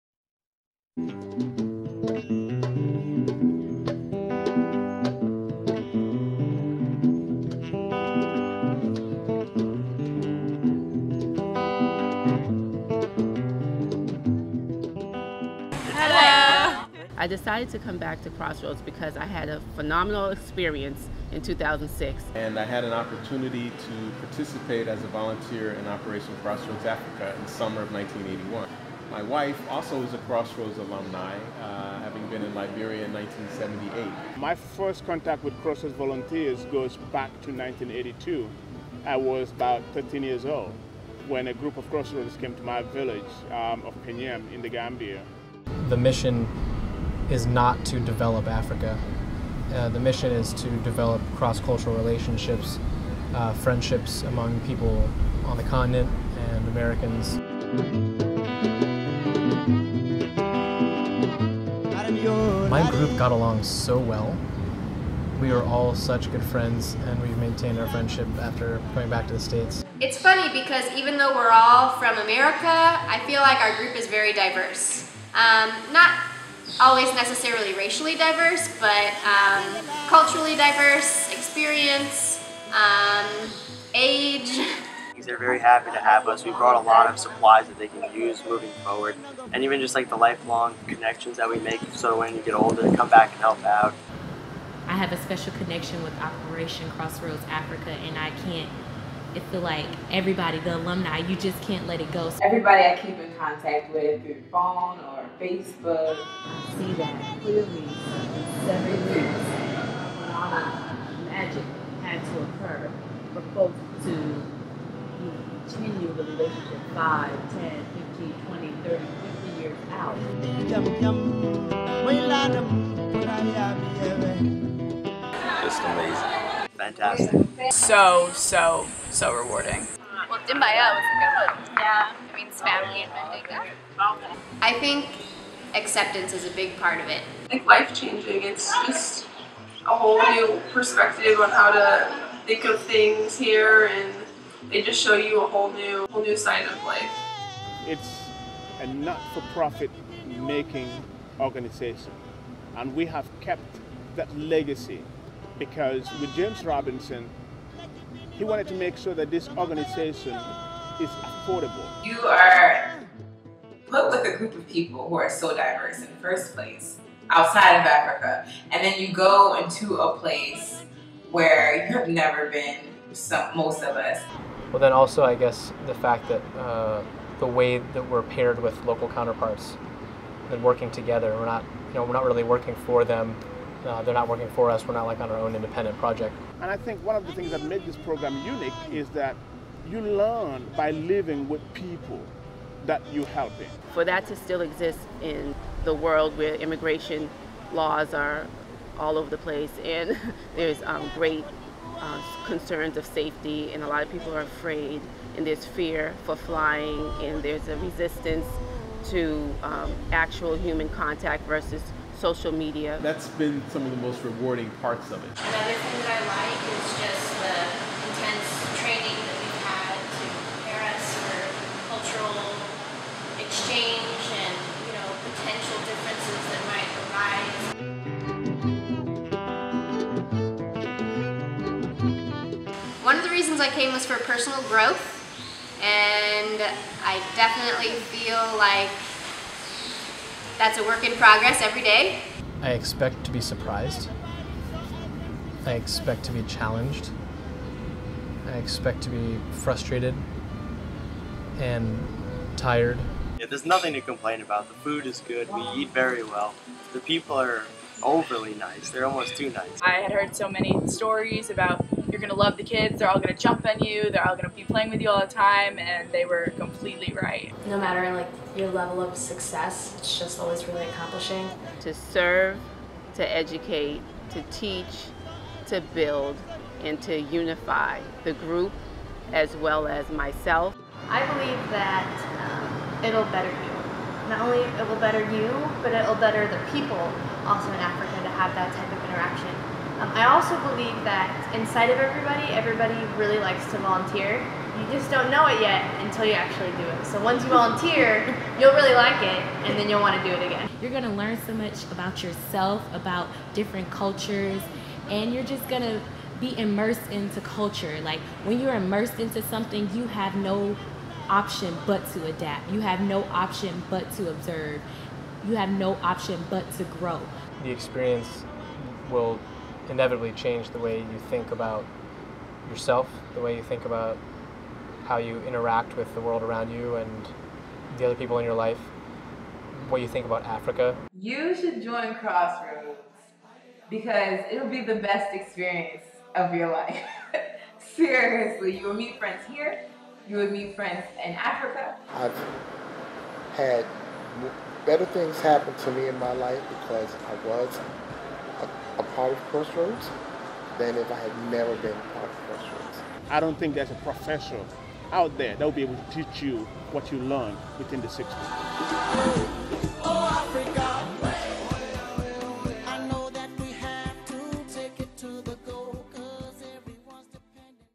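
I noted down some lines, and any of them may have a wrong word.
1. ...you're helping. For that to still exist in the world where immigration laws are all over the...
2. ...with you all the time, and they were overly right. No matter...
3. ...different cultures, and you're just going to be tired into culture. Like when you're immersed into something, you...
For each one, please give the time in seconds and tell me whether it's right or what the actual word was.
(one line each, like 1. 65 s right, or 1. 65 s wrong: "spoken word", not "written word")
1. 193 s right
2. 264 s wrong: "completely", not "overly"
3. 303 s wrong: "immersed", not "tired".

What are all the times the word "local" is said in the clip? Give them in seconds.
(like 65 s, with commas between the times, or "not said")
178 s.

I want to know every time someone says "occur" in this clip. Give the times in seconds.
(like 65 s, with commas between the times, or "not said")
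112 s.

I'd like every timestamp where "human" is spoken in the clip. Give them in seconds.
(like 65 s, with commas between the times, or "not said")
210 s.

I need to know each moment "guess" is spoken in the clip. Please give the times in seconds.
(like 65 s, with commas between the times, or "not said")
175 s.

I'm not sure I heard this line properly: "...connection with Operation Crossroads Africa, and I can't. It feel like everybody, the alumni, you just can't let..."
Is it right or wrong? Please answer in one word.
right.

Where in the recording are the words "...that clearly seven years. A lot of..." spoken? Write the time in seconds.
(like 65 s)
106 s.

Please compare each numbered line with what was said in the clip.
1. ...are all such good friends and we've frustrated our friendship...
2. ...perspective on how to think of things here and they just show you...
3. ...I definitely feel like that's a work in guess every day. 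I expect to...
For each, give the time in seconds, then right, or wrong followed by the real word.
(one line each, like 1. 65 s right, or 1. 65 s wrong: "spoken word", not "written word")
1. 65 s wrong: "maintained", not "frustrated"
2. 140 s right
3. 237 s wrong: "progress", not "guess".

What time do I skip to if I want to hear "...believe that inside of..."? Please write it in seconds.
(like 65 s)
290 s.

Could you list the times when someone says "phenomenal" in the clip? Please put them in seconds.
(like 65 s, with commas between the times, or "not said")
19 s.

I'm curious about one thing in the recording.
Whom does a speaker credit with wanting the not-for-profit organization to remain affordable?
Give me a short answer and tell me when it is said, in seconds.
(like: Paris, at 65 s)
James Robinson, at 156 s.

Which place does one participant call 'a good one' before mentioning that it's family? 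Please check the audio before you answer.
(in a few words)
Dimbaya.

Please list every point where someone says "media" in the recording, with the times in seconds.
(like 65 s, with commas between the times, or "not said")
212 s.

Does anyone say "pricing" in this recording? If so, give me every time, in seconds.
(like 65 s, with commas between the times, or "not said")
not said.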